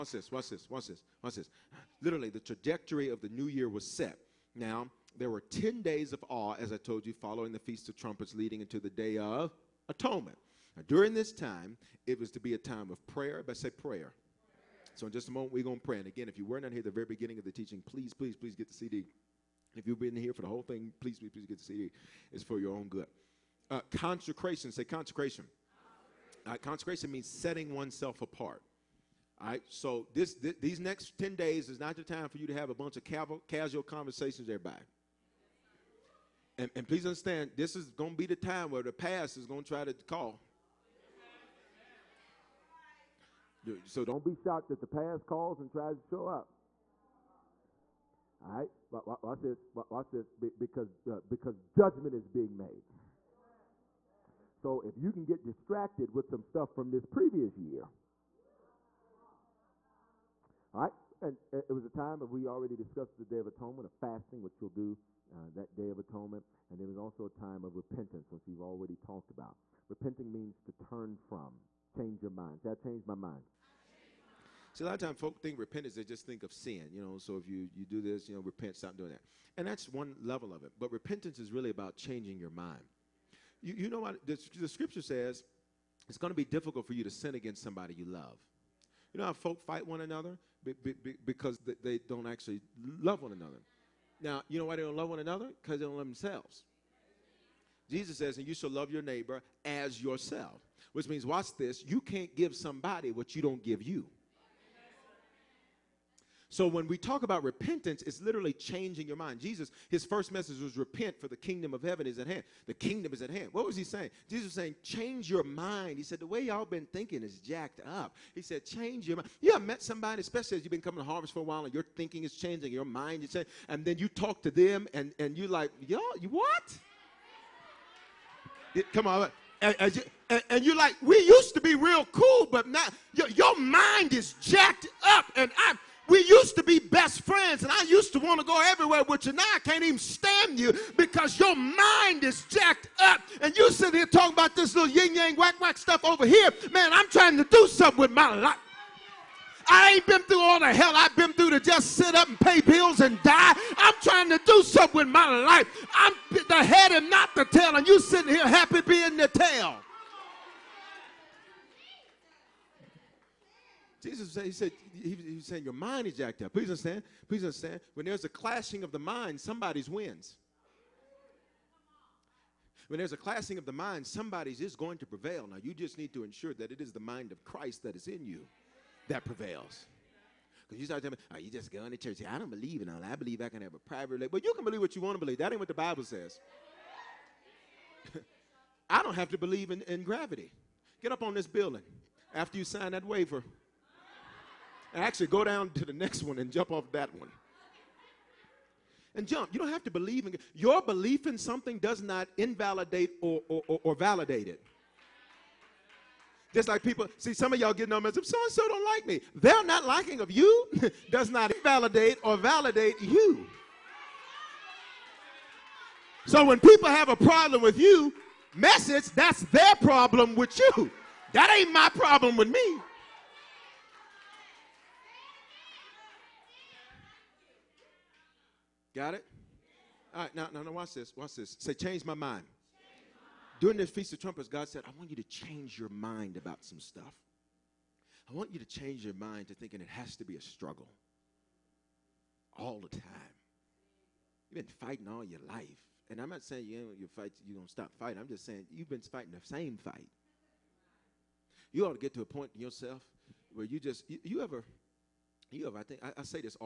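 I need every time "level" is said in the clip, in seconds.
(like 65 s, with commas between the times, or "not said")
80 s.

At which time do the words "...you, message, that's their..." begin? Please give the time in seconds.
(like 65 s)
217 s.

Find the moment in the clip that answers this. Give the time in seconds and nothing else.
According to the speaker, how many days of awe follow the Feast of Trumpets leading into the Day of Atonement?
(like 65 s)
5 s.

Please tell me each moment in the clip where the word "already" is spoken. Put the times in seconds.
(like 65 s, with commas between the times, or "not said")
62 s, 68 s.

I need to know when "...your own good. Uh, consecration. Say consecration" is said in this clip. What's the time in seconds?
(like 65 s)
22 s.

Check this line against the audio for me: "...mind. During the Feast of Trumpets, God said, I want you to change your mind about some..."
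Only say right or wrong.
right.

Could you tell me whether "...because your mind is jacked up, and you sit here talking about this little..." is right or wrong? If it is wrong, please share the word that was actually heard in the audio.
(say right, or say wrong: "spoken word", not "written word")
right.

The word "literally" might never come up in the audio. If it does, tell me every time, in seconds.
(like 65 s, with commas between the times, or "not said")
2 s, 108 s.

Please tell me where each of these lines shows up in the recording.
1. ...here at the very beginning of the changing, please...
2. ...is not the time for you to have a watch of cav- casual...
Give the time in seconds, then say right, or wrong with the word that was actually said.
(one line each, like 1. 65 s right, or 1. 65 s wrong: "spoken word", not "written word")
1. 16 s wrong: "teaching", not "changing"
2. 31 s wrong: "bunch", not "watch".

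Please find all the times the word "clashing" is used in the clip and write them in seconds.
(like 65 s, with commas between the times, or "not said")
168 s, 173 s.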